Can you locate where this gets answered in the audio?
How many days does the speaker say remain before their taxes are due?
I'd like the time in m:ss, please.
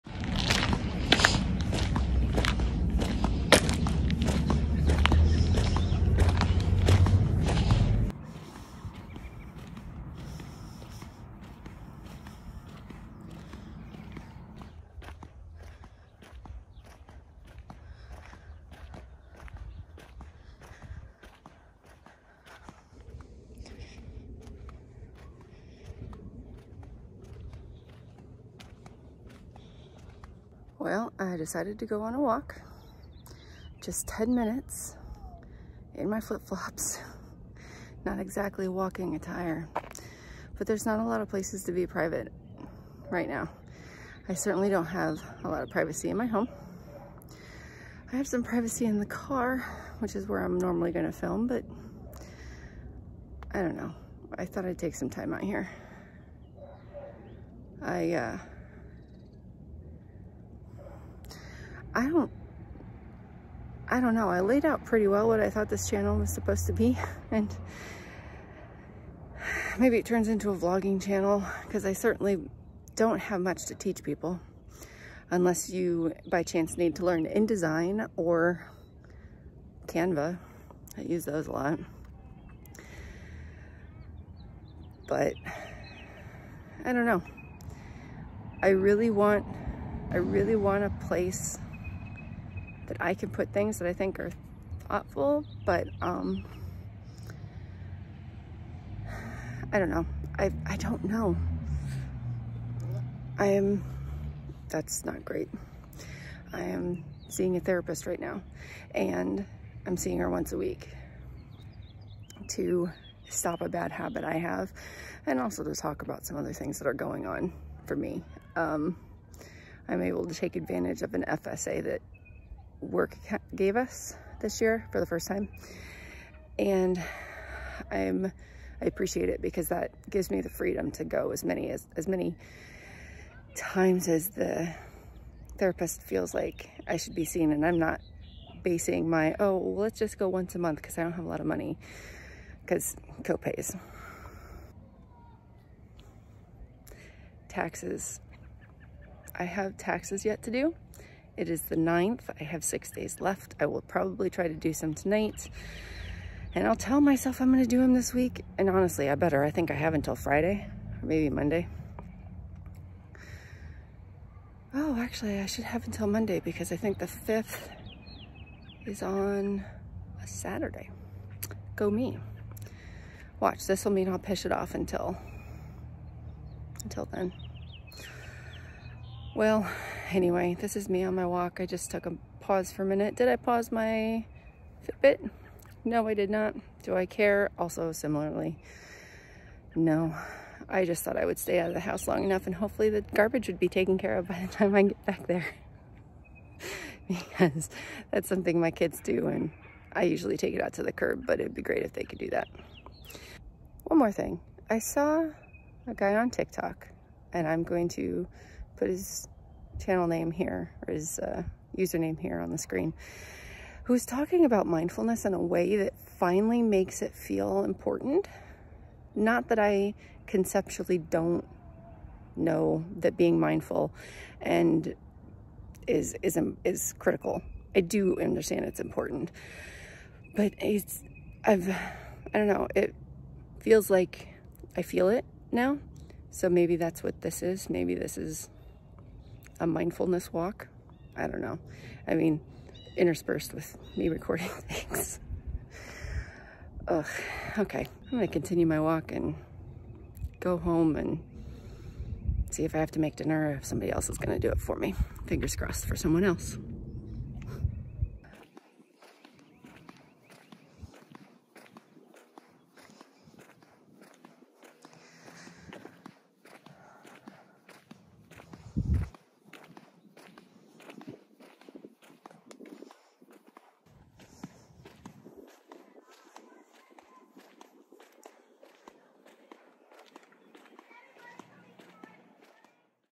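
2:32.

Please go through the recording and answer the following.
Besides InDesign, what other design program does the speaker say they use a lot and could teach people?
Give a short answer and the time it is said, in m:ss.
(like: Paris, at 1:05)
Canva, at 1:19.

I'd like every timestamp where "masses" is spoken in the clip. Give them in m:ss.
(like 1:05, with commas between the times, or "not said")
not said.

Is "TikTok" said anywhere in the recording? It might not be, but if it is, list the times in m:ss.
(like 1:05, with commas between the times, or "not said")
3:26.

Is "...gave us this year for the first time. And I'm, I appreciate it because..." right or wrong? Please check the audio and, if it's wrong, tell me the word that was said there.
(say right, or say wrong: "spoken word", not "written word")
right.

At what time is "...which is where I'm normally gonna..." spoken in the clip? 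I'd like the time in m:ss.
0:49.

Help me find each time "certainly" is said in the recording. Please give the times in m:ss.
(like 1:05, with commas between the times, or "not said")
0:44, 1:11.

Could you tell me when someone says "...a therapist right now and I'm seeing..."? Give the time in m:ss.
1:47.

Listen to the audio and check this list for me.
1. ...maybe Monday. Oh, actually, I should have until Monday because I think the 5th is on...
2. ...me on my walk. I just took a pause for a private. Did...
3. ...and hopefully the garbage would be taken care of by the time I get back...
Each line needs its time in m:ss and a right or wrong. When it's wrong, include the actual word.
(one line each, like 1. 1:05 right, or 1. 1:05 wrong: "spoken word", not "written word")
1. 2:41 right
2. 3:00 wrong: "minute", not "private"
3. 3:12 right.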